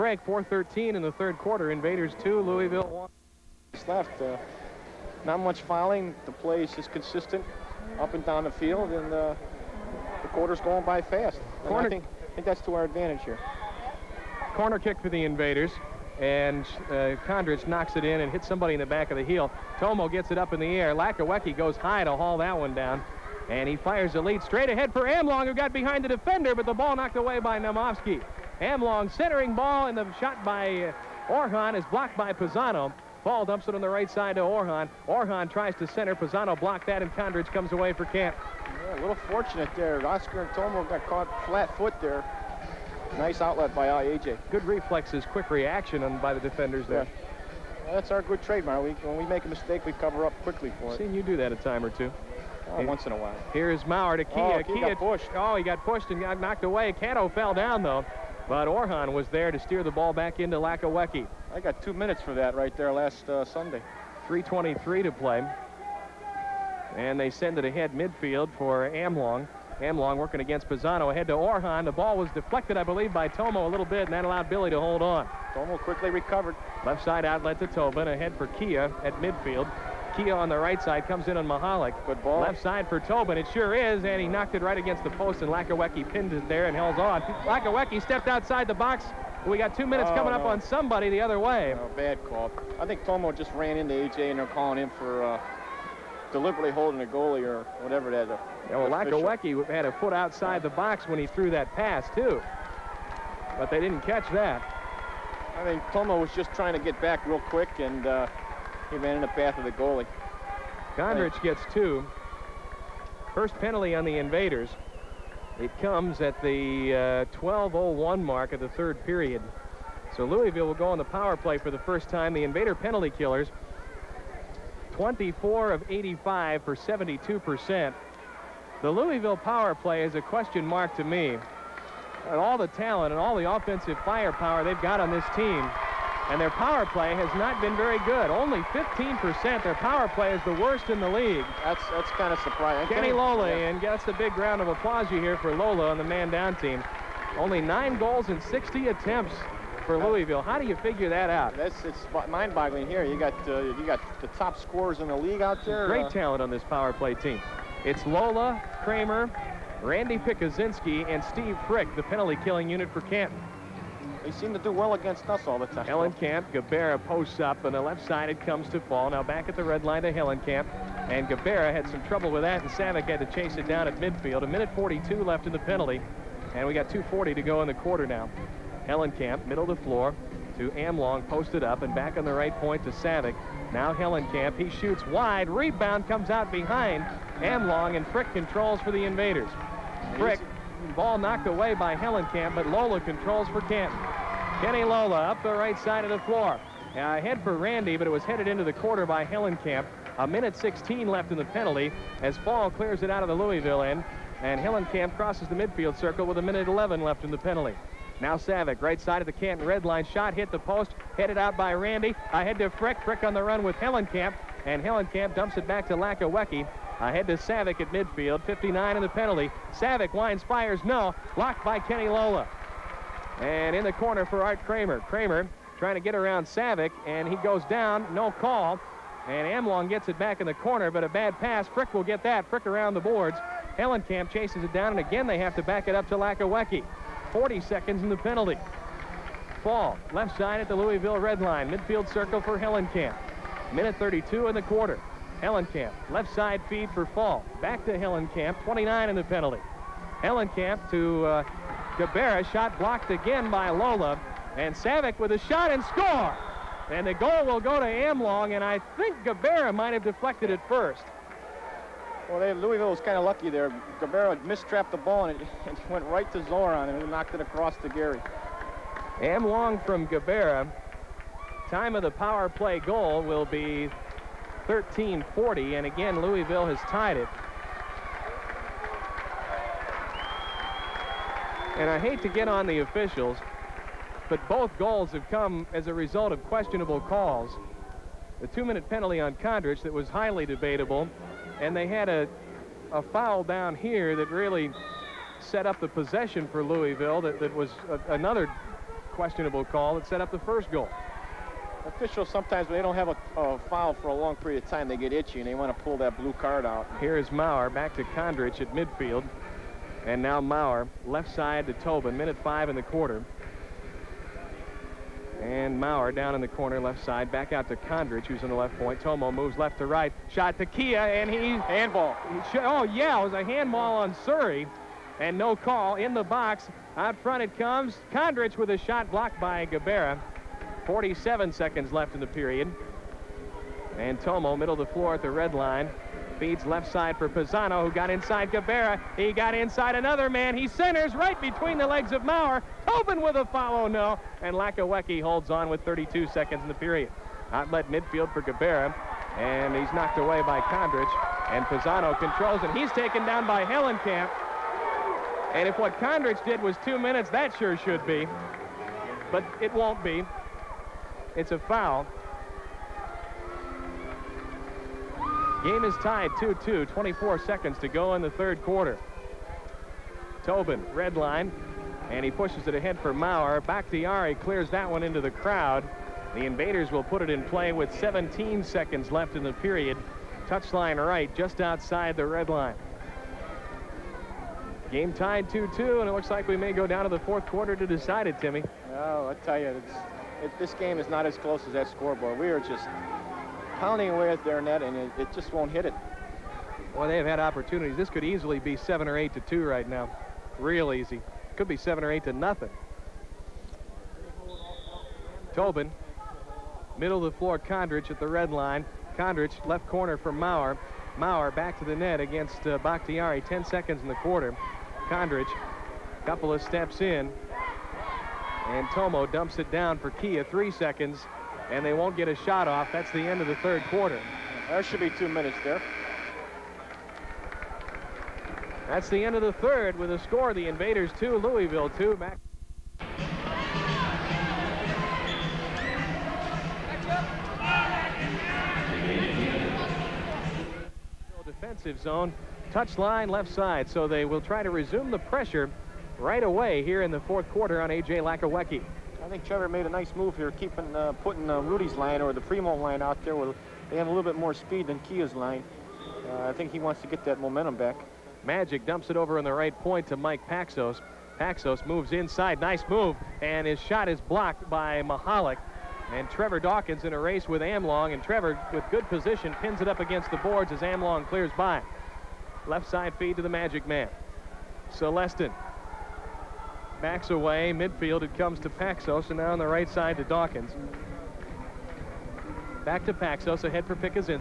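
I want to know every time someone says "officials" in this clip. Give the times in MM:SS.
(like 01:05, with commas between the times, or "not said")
04:42, 05:01.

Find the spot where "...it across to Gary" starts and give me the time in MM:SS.
04:27.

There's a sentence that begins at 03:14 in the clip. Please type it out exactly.
Kenny Lola up the right side of the floor.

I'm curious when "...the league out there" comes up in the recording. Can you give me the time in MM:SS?
02:35.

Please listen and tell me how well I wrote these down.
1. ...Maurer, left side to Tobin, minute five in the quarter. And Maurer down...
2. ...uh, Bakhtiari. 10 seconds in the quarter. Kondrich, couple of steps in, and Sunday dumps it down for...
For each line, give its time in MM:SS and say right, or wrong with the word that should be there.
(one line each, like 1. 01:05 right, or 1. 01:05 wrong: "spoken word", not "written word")
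1. 05:10 right
2. 06:52 wrong: "Tomo", not "Sunday".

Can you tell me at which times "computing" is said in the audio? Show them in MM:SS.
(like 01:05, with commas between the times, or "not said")
not said.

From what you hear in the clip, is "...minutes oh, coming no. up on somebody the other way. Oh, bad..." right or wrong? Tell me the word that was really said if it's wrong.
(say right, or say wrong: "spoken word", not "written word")
right.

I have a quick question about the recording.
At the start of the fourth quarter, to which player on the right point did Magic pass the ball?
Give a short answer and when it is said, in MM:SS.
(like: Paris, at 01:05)
Mike Paxos, at 07:40.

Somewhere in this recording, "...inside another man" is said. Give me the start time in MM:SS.
05:39.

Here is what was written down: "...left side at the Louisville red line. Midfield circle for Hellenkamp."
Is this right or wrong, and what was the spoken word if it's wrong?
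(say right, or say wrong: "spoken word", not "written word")
right.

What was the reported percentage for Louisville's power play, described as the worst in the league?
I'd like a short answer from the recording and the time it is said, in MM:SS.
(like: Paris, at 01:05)
15%, at 02:18.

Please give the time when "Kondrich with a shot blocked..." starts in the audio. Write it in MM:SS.
05:28.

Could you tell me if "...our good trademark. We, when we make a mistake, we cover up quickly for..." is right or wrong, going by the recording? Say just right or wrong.
right.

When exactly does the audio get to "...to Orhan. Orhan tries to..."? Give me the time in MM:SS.
00:34.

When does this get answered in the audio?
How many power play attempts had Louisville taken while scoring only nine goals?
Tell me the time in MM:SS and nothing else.
02:28.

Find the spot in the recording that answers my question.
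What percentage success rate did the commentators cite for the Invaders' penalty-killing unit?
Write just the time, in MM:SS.
02:06.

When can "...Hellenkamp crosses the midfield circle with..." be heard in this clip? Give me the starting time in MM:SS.
03:24.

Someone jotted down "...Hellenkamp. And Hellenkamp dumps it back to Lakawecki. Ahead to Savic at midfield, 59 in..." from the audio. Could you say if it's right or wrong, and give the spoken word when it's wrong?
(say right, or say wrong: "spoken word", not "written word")
right.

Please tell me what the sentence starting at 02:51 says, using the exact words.
And Gabera had some trouble with that, and Savic had to chase it down at midfield.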